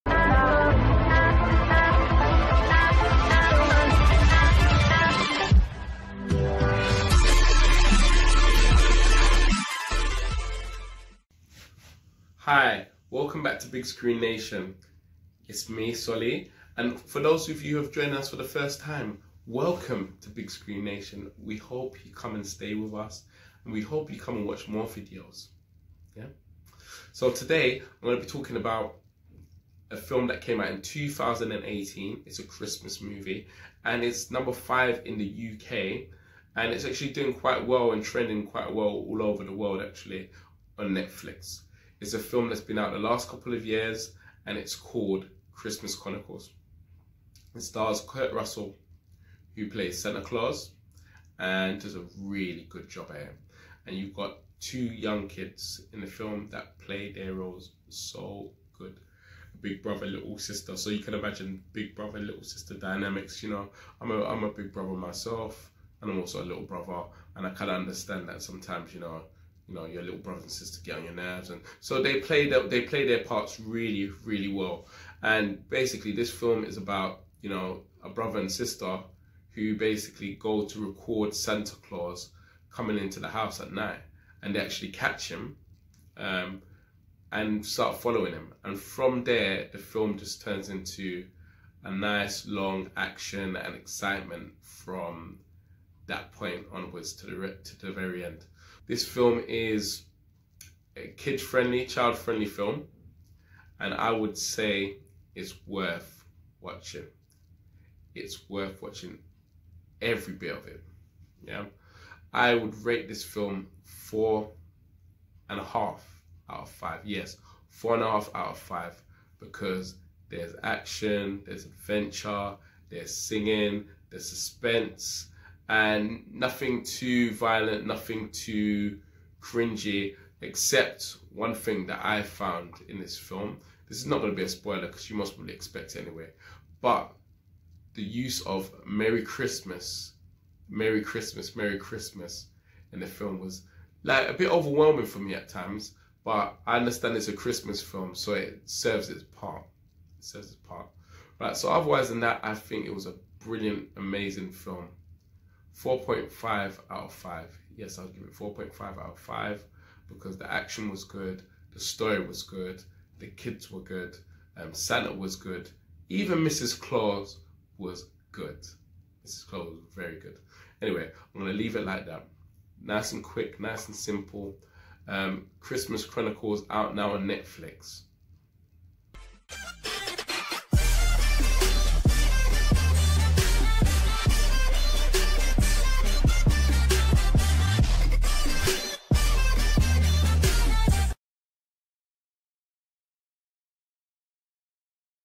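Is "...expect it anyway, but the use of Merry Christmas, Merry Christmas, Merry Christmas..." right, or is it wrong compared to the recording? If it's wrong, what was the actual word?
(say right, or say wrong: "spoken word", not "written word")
right.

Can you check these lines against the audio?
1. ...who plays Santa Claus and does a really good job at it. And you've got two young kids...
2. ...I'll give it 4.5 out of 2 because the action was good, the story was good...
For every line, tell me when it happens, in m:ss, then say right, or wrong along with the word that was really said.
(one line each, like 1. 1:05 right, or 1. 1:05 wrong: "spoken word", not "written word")
1. 0:49 right
2. 2:37 wrong: "5", not "2".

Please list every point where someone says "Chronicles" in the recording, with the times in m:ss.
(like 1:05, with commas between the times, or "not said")
0:45, 2:56.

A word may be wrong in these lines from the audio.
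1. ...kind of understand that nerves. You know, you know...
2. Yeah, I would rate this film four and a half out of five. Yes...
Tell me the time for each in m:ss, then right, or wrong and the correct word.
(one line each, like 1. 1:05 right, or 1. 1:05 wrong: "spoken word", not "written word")
1. 1:07 wrong: "sometimes", not "nerves"
2. 1:51 right.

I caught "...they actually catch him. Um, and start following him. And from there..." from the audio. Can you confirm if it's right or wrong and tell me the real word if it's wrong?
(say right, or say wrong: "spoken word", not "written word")
right.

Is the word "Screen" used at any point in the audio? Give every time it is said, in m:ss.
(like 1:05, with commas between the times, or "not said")
0:13, 0:20.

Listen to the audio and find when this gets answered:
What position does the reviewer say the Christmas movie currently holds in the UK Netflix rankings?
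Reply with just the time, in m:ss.
0:34.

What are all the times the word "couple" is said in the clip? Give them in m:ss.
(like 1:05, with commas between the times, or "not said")
0:43.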